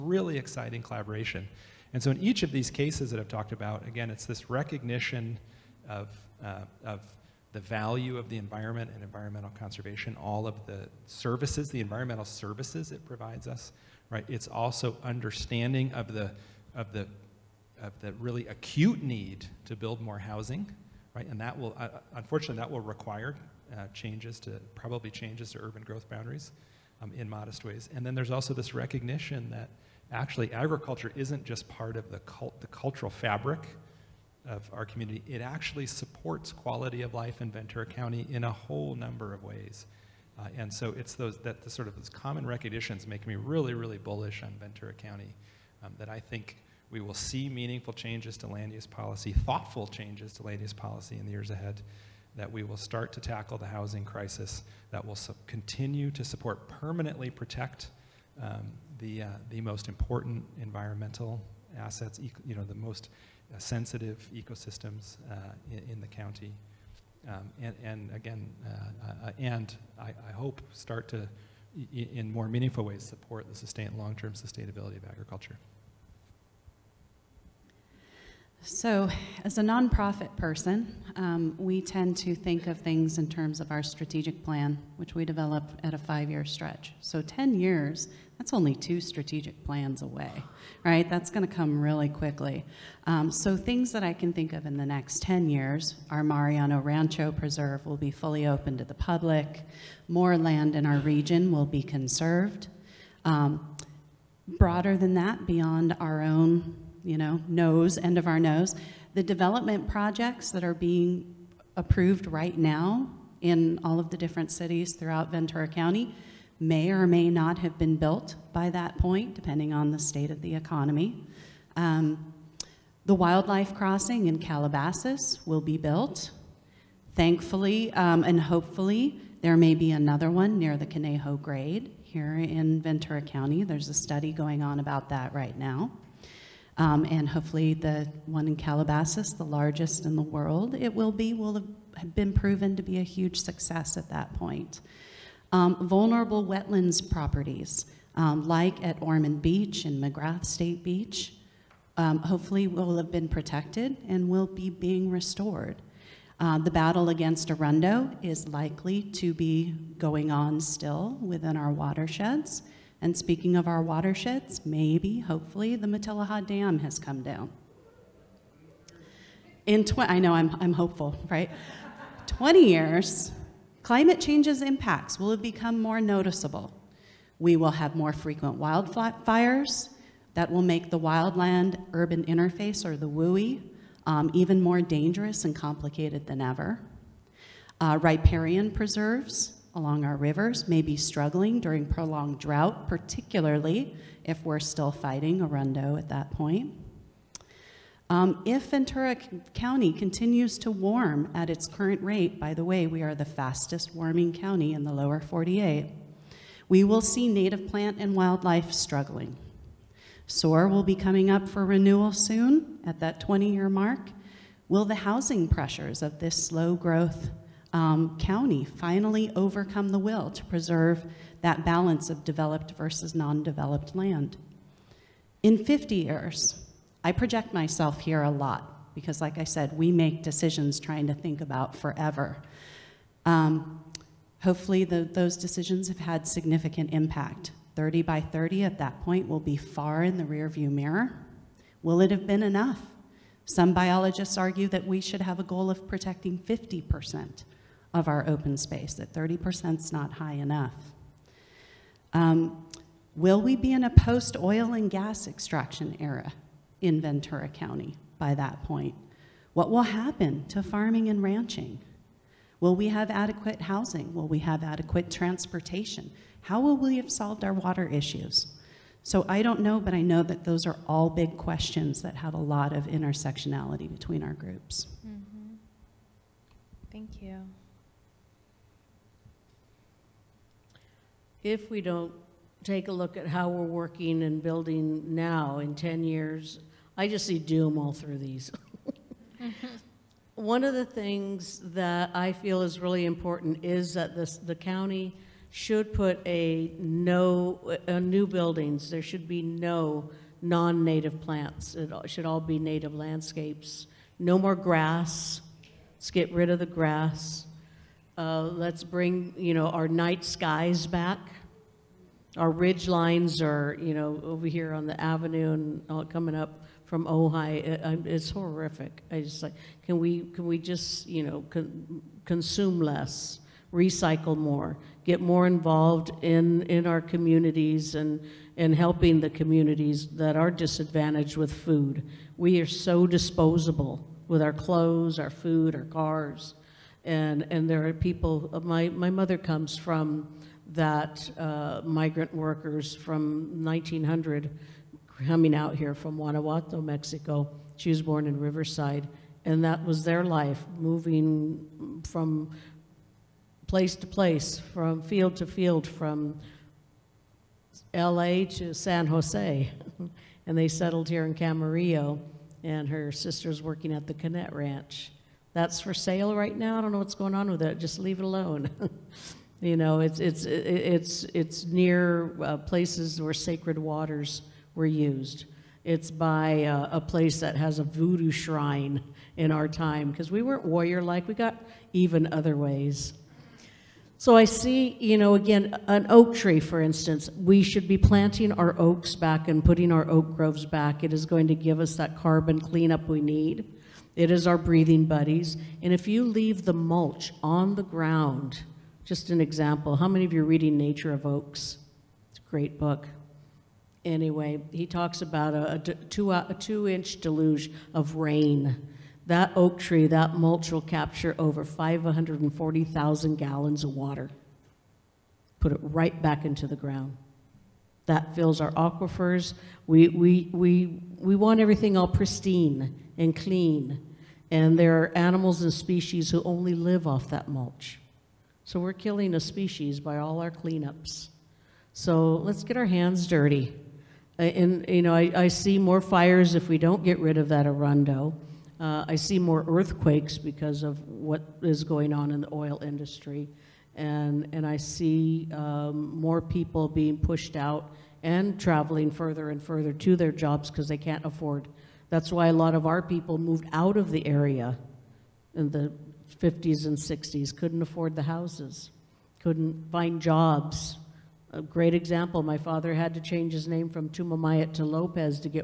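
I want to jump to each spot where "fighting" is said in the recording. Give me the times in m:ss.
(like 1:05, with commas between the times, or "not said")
3:14.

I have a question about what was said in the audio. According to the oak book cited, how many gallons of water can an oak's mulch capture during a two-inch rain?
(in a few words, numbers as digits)
540,000.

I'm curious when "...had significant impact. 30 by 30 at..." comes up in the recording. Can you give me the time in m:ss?
3:55.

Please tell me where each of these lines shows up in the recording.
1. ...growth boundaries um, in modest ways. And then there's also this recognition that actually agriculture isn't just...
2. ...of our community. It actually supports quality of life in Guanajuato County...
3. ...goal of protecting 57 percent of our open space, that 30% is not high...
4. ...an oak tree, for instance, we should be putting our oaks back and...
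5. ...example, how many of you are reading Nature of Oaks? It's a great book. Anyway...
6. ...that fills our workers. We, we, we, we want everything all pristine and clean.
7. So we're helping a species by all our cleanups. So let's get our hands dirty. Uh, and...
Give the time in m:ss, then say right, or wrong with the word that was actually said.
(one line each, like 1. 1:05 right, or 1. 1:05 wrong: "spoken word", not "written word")
1. 0:25 right
2. 0:34 wrong: "Ventura", not "Guanajuato"
3. 4:05 wrong: "50", not "57"
4. 6:25 wrong: "planting", not "putting"
5. 6:39 right
6. 6:58 wrong: "aquifers", not "workers"
7. 7:08 wrong: "killing", not "helping".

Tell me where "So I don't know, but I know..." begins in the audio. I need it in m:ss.
4:29.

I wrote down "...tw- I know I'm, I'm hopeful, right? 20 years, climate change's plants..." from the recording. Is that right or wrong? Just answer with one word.
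wrong.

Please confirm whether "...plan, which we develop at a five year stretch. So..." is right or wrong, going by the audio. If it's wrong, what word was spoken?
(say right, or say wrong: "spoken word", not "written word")
right.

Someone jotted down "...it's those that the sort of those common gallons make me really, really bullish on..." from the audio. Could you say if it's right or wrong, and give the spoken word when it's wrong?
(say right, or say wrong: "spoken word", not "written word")
wrong: "recognitions", not "gallons".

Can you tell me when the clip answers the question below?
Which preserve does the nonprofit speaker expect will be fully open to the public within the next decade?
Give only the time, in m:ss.
1:36.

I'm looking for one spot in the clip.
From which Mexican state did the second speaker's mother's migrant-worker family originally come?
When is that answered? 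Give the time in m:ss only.
5:46.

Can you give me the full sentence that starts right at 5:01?
It should all be native landscapes.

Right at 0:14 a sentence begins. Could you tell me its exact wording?
It's also understanding of the, of the, of the really acute need to build more housing, right?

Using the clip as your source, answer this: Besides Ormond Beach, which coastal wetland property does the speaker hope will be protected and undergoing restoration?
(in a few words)
McGrath State Beach.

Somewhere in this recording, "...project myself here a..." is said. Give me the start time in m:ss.
3:47.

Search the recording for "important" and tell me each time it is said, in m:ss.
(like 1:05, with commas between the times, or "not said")
0:59, 4:53.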